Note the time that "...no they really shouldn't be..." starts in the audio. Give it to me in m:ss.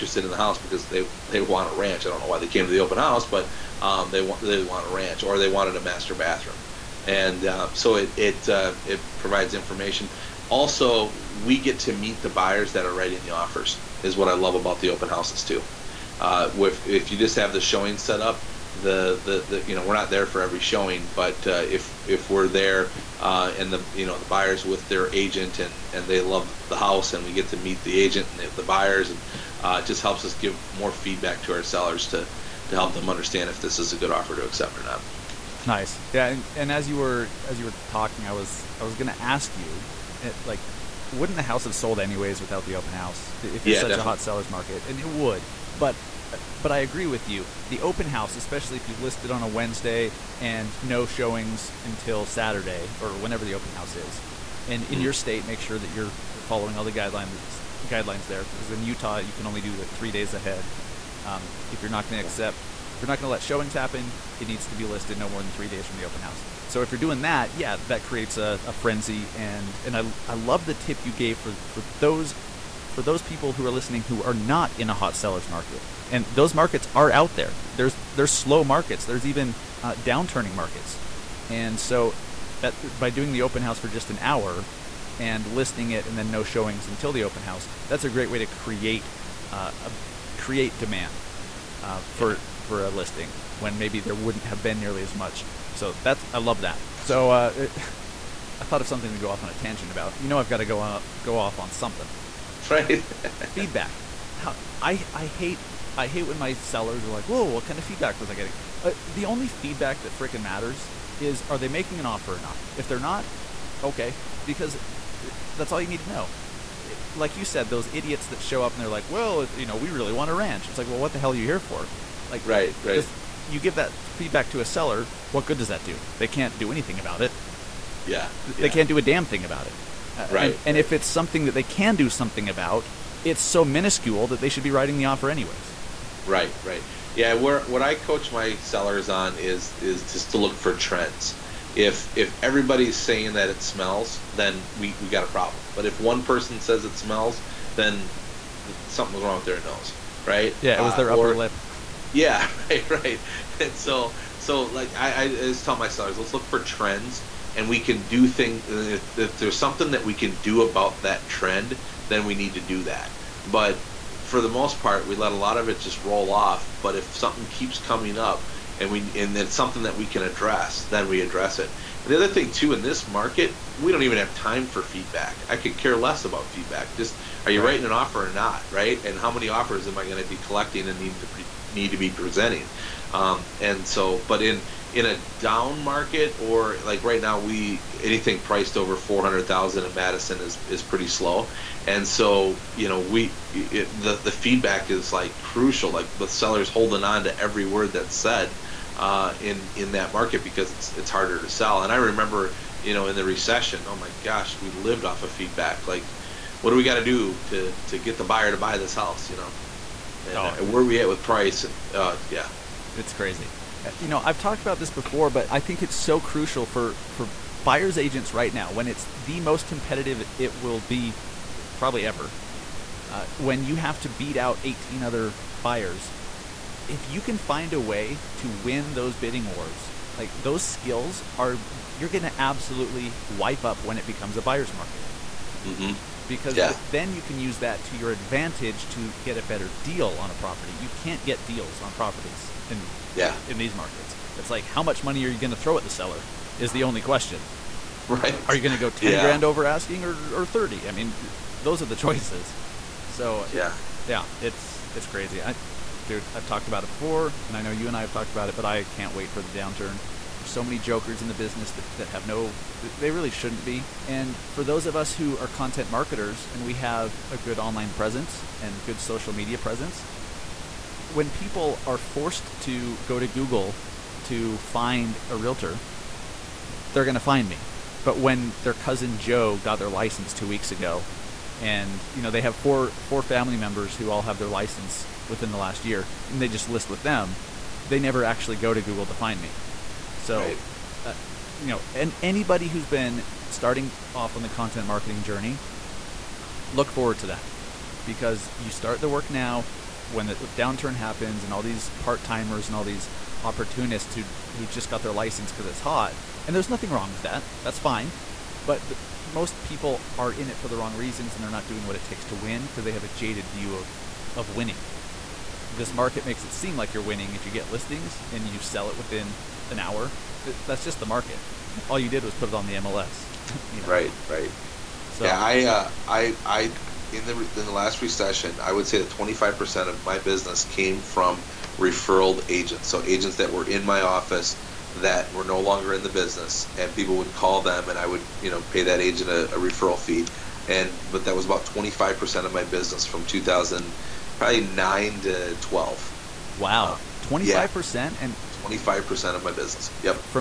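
4:22.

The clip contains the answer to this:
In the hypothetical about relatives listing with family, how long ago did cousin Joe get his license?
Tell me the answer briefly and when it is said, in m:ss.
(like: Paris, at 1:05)
2 weeks, at 4:40.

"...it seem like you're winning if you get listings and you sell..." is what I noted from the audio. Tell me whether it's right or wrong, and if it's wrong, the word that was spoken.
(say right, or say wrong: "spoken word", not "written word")
right.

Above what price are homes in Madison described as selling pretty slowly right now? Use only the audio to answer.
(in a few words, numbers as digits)
$400,000.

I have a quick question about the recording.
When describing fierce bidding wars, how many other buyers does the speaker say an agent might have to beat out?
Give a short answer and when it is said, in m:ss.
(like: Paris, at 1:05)
18, at 3:44.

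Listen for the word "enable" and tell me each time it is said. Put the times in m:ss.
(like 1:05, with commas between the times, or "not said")
not said.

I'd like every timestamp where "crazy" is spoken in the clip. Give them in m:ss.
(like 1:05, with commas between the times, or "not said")
3:33, 4:15.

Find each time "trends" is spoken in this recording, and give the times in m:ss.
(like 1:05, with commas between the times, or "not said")
2:20, 2:36, 2:41.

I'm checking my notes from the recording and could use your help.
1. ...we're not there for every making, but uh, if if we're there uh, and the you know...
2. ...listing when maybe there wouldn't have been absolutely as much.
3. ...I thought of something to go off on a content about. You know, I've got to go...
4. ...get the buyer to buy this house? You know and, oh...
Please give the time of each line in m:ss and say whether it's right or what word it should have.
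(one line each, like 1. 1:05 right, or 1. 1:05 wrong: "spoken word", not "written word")
1. 0:19 wrong: "showing", not "making"
2. 1:32 wrong: "nearly", not "absolutely"
3. 1:38 wrong: "tangent", not "content"
4. 3:27 right.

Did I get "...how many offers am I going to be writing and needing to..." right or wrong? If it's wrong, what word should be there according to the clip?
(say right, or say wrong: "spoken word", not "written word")
wrong: "collecting", not "writing".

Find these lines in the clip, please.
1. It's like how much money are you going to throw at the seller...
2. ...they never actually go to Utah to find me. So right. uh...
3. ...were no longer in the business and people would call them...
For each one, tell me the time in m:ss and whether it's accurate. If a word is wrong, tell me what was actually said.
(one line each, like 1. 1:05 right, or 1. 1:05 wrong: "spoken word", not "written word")
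1. 4:04 right
2. 4:47 wrong: "Google", not "Utah"
3. 5:35 right.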